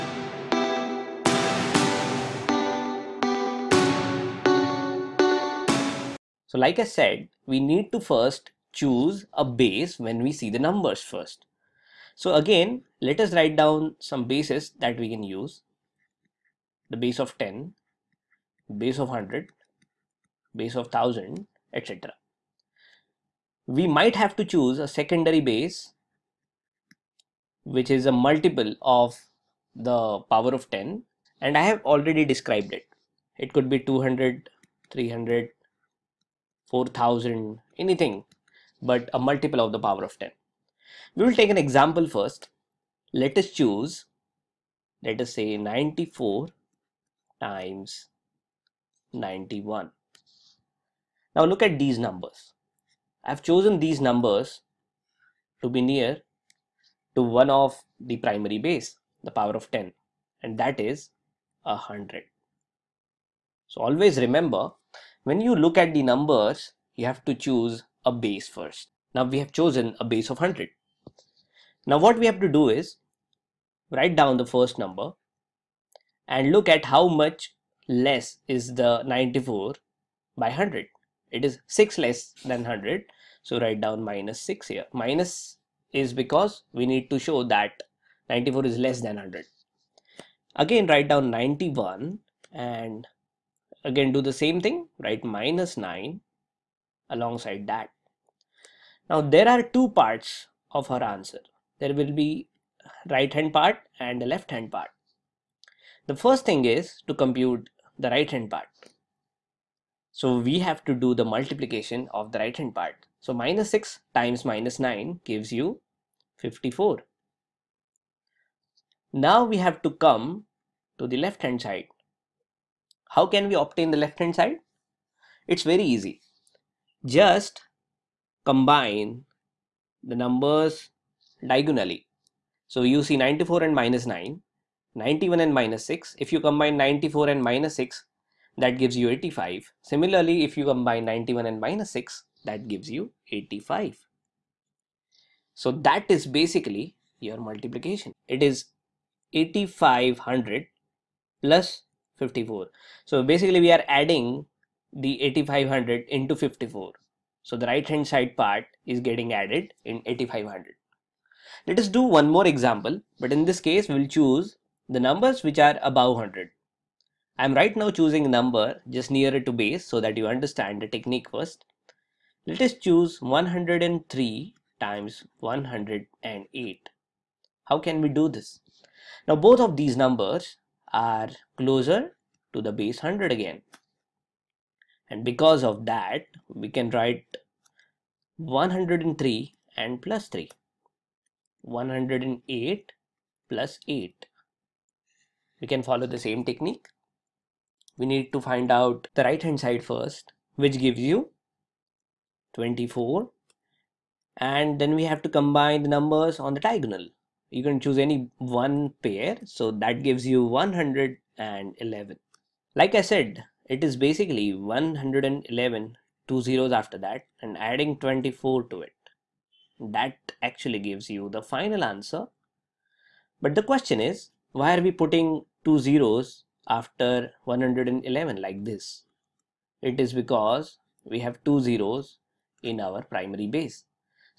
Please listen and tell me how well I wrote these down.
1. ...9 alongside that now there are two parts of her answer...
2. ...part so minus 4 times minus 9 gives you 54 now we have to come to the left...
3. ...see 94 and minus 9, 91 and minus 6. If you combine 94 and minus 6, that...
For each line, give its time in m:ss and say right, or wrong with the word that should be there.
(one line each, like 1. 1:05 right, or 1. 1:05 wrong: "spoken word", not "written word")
1. 1:35 right
2. 1:52 wrong: "6", not "4"
3. 2:13 right.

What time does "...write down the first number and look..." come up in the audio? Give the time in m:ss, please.
1:13.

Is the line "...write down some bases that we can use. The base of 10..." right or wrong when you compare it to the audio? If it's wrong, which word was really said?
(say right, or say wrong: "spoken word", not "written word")
right.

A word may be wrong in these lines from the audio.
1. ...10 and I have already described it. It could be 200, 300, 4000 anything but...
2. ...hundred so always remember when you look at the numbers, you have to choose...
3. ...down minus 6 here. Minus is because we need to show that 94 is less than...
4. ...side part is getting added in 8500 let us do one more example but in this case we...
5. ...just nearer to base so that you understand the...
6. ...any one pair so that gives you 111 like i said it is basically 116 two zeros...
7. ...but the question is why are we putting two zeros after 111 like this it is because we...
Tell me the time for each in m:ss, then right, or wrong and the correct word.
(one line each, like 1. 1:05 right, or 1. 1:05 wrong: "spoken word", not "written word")
1. 0:30 right
2. 1:01 right
3. 1:23 right
4. 2:38 right
5. 2:48 right
6. 3:27 wrong: "111", not "116"
7. 3:43 right.